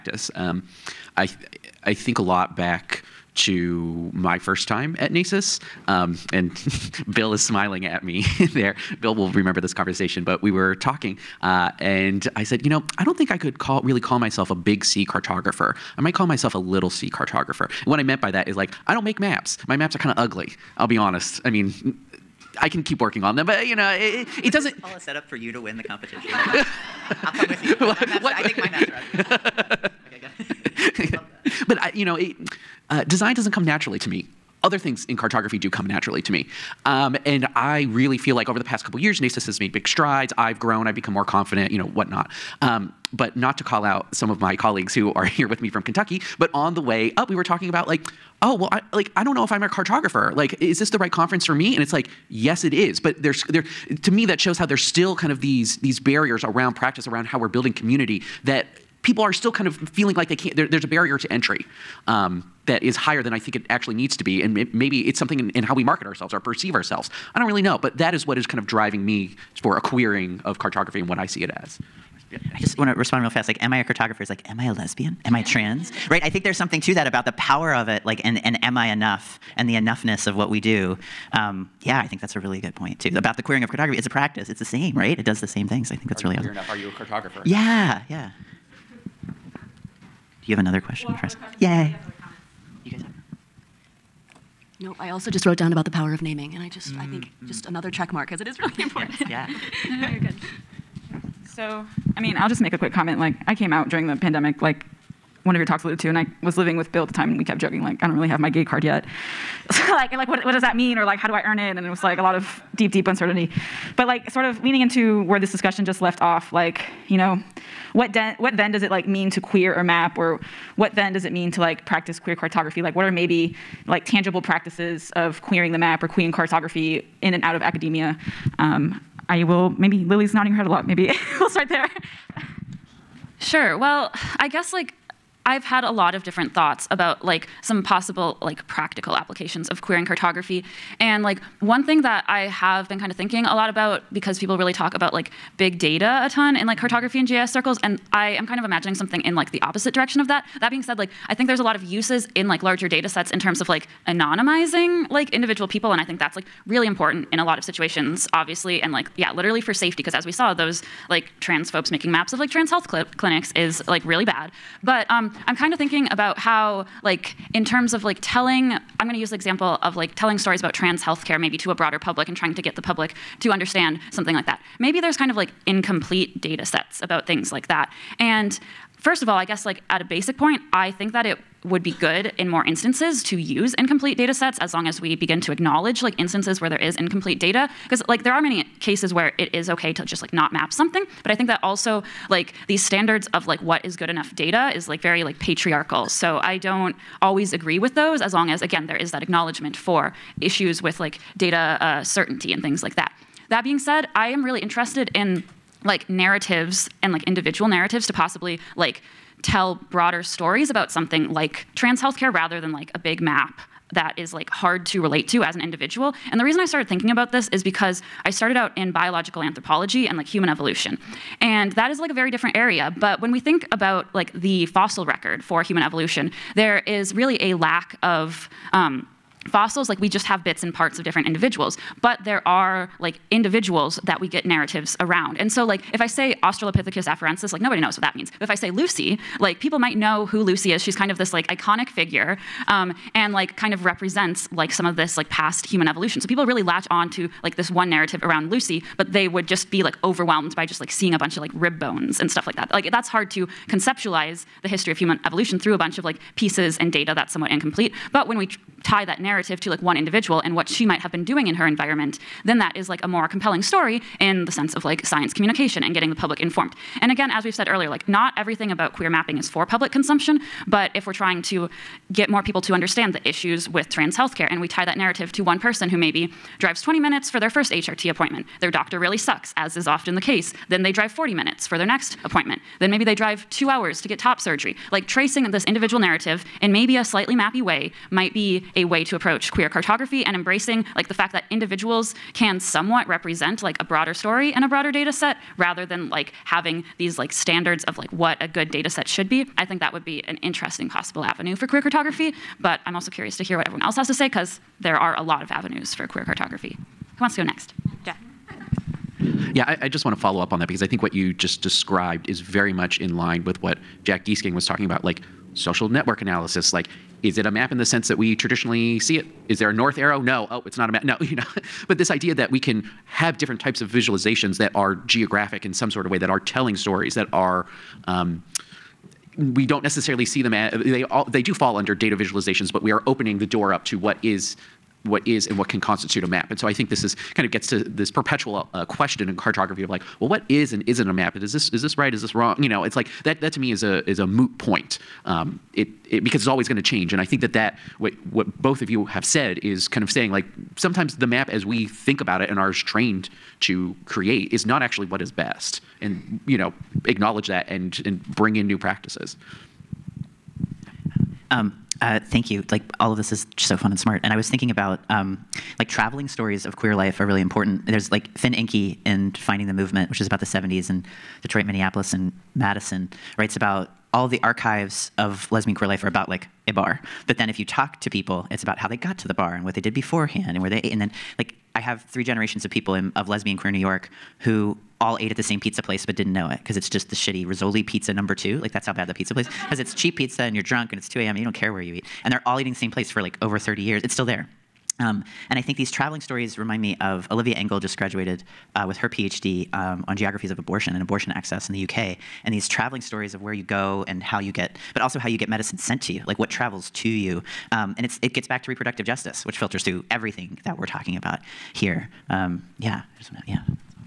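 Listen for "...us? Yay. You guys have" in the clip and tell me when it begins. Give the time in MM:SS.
01:31.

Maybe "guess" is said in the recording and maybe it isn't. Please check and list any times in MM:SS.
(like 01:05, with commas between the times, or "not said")
02:14, 02:59.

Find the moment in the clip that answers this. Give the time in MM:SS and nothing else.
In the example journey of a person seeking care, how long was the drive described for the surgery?
04:43.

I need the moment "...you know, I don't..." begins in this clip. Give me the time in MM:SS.
00:12.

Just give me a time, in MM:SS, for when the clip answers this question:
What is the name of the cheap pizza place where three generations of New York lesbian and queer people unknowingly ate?
06:27.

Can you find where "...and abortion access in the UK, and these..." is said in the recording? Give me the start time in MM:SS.
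06:40.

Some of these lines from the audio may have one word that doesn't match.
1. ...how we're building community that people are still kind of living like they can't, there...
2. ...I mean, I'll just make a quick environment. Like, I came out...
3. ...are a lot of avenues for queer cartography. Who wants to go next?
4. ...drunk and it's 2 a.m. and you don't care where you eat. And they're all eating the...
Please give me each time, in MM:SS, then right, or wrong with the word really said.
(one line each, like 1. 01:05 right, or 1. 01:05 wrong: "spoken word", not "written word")
1. 00:57 wrong: "feeling", not "living"
2. 01:42 wrong: "comment", not "environment"
3. 05:04 right
4. 06:30 right.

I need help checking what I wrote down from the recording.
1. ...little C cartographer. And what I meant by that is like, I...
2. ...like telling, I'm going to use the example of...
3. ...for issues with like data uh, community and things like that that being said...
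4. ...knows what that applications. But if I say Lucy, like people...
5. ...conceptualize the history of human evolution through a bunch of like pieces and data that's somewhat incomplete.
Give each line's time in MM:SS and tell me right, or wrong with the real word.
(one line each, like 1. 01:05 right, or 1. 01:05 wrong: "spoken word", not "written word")
1. 00:16 right
2. 02:48 right
3. 03:19 wrong: "certainty", not "community"
4. 03:57 wrong: "means", not "applications"
5. 04:13 right.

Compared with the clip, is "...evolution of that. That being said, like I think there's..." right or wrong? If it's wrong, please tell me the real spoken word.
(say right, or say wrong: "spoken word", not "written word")
wrong: "direction", not "evolution".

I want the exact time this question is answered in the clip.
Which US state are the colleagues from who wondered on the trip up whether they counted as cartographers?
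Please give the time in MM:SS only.
00:45.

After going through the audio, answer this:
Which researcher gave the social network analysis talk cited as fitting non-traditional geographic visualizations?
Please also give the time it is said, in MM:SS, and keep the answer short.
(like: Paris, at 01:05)
Jack Gieseking, at 05:14.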